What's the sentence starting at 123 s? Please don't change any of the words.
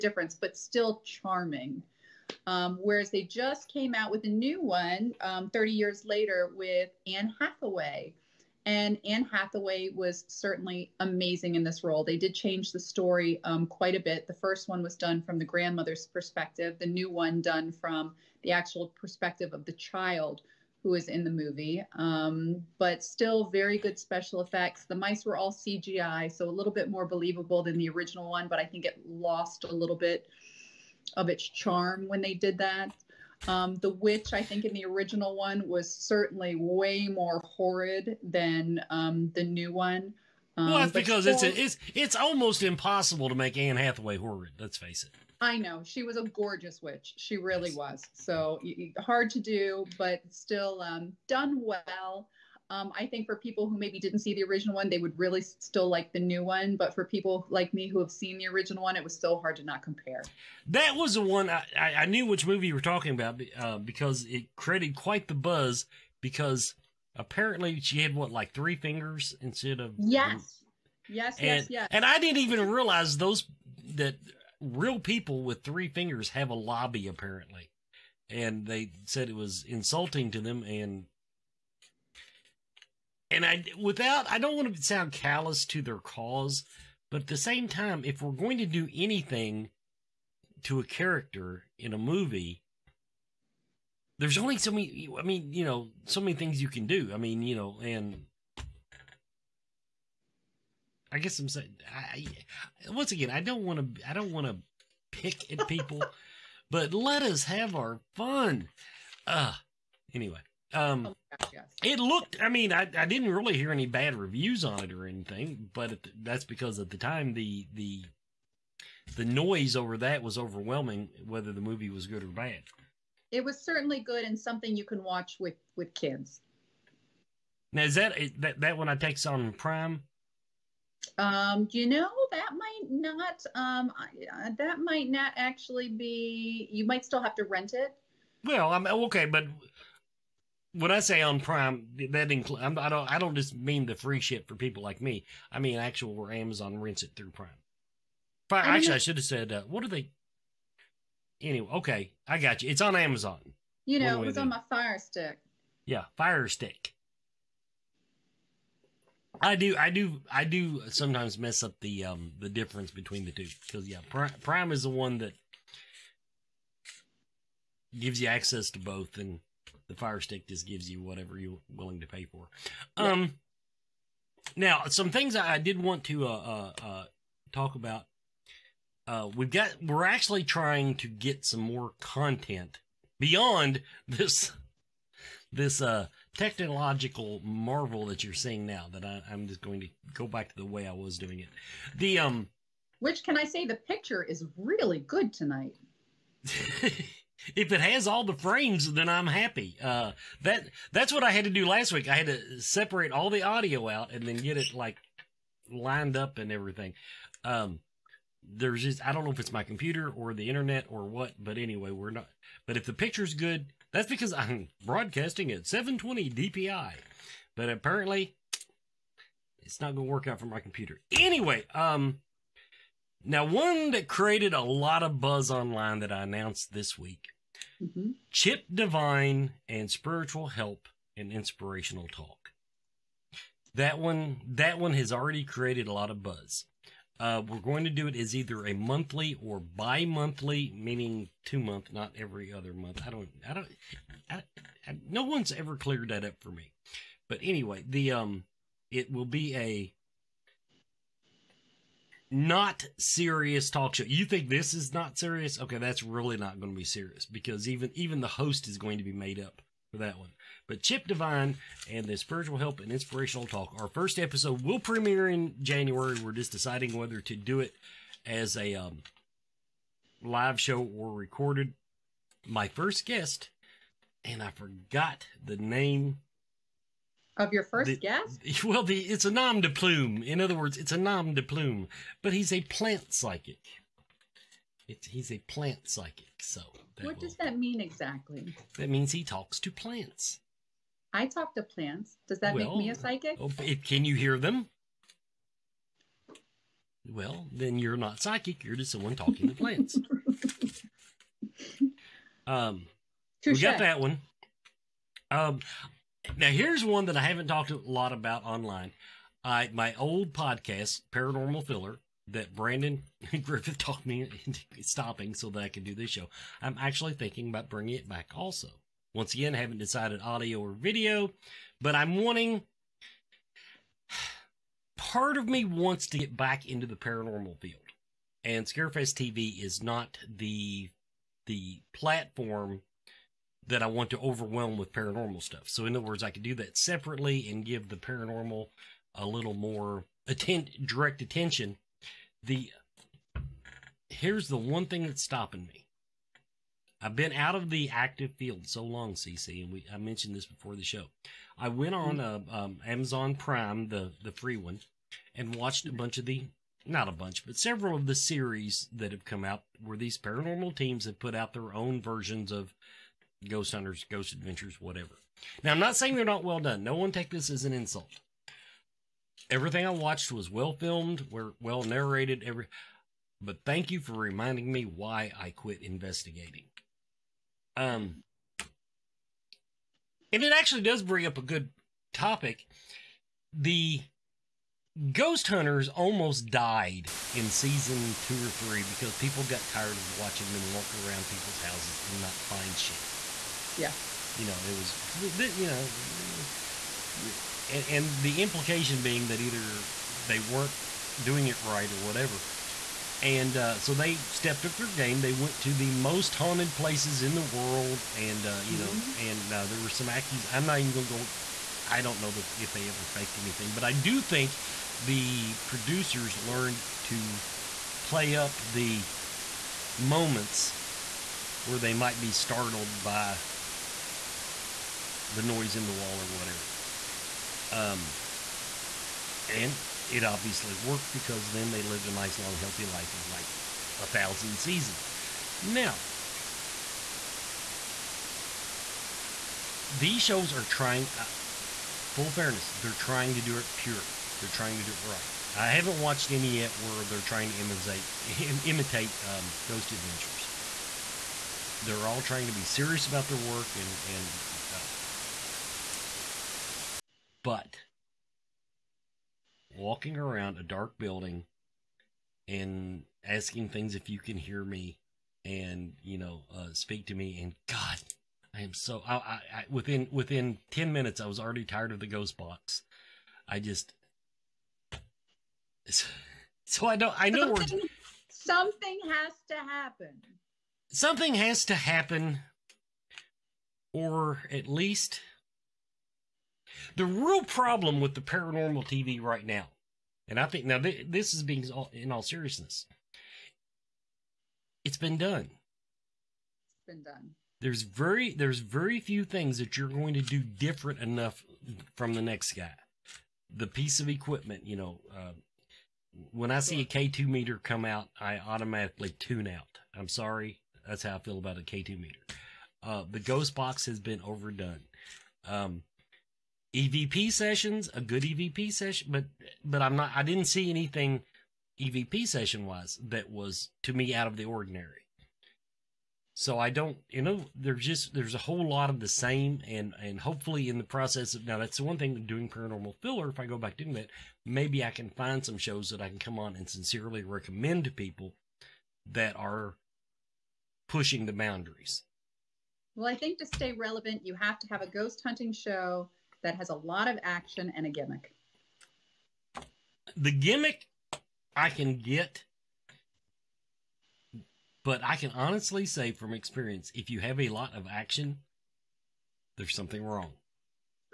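It was certainly good and something you can watch with with kids.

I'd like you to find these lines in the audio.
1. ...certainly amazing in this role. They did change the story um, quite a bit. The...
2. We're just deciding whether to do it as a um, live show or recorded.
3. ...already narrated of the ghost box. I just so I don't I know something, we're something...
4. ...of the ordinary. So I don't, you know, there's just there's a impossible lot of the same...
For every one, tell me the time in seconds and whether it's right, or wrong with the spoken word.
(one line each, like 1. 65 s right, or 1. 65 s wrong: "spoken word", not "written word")
1. 10 s right
2. 266 s right
3. 471 s wrong: "tired", not "narrated"
4. 524 s wrong: "whole", not "impossible".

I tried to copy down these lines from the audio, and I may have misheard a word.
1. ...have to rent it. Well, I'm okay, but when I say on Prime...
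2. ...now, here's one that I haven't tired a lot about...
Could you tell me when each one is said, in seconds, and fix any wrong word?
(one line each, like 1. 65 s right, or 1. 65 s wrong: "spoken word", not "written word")
1. 137 s right
2. 306 s wrong: "talked", not "tired".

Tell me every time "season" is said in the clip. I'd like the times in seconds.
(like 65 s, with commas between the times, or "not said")
387 s, 434 s.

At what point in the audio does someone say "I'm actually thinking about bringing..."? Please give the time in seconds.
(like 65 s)
316 s.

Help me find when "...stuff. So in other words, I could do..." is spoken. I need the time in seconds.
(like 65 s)
335 s.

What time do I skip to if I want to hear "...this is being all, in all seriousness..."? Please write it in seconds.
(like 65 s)
491 s.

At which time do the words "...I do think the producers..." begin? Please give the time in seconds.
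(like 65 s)
413 s.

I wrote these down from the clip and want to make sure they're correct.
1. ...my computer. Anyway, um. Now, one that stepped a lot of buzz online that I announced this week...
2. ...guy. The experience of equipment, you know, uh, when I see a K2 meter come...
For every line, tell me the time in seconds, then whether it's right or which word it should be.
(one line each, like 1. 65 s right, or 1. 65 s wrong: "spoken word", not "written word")
1. 220 s wrong: "created", not "stepped"
2. 502 s wrong: "piece", not "experience".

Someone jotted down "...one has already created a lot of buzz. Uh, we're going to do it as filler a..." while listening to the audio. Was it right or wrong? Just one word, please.
wrong.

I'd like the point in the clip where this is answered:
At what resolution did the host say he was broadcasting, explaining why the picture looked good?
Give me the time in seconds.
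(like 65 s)
215 s.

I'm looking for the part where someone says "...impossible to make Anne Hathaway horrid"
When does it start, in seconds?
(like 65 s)
42 s.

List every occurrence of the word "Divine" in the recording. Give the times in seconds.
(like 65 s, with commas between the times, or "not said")
228 s, 261 s.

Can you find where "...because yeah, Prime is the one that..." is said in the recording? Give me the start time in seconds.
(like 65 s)
163 s.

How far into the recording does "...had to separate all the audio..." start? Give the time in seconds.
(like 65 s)
202 s.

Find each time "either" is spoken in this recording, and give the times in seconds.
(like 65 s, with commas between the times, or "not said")
238 s, 399 s.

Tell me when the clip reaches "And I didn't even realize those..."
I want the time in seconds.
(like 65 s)
71 s.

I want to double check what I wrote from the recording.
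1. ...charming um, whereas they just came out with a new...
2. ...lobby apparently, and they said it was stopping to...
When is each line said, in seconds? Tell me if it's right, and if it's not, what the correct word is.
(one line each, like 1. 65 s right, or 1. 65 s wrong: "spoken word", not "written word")
1. 1 s right
2. 76 s wrong: "insulting", not "stopping".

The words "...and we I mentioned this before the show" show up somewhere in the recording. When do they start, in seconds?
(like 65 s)
349 s.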